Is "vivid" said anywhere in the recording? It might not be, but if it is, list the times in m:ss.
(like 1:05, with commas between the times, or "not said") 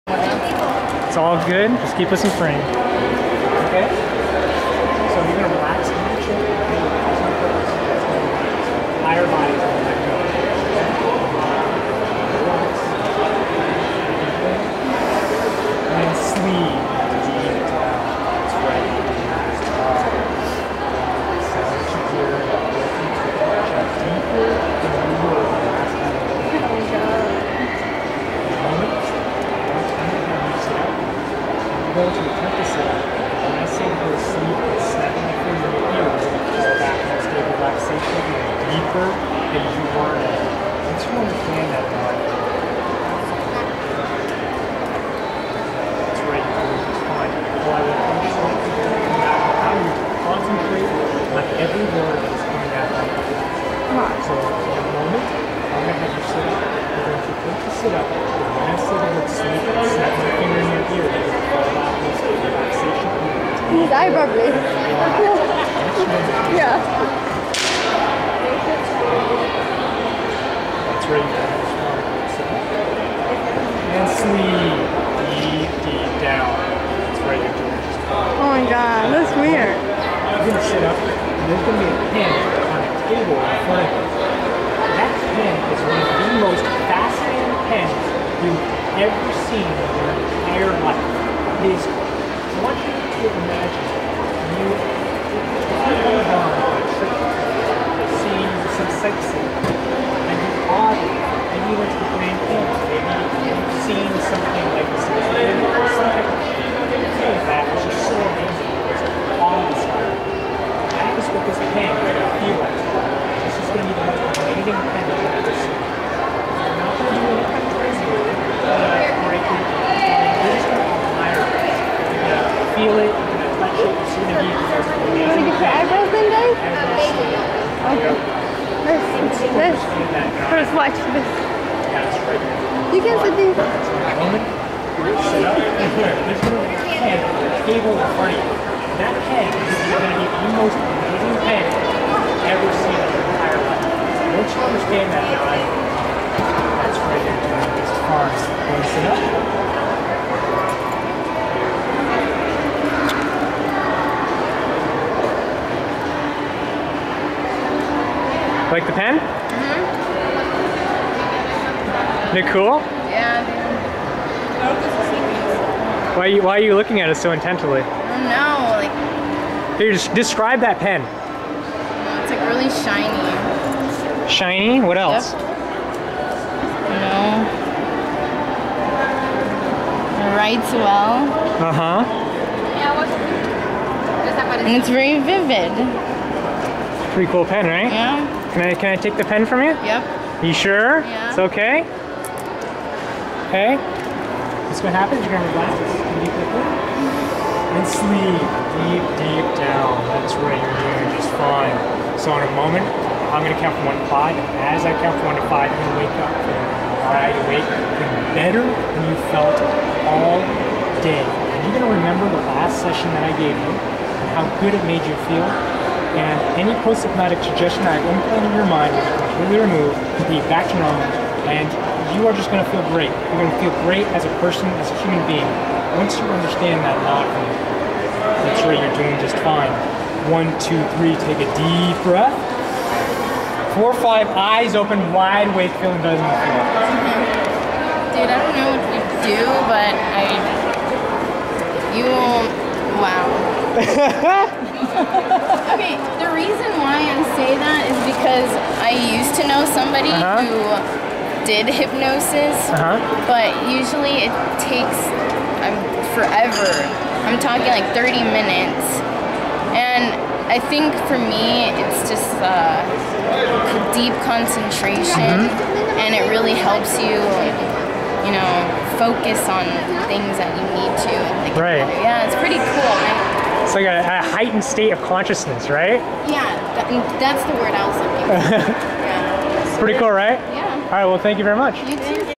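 3:05.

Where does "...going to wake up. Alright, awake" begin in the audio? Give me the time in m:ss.
3:25.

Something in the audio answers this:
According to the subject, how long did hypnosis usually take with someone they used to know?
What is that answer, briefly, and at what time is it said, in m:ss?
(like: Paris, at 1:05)
30 minutes, at 4:17.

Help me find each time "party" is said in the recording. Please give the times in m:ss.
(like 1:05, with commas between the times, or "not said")
2:18.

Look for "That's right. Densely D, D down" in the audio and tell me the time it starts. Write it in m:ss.
1:10.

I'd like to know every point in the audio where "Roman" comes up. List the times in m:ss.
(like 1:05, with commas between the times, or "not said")
2:14.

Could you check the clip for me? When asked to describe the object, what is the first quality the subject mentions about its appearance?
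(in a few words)
Really shiny.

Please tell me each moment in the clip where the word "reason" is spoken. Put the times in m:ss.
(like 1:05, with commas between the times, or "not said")
4:06.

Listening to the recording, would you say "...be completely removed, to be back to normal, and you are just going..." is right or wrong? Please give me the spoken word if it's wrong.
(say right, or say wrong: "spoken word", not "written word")
right.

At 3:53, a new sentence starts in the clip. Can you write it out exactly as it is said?
Four, five, eyes open, wide awake, feeling better than mm-hmm.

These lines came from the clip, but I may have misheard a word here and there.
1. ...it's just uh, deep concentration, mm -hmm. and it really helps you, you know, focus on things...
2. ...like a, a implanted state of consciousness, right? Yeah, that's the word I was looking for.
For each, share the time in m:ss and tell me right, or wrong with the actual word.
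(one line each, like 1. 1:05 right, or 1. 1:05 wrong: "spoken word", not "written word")
1. 4:21 right
2. 4:33 wrong: "heightened", not "implanted".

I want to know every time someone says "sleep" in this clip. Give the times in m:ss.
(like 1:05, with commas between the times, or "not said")
3:17.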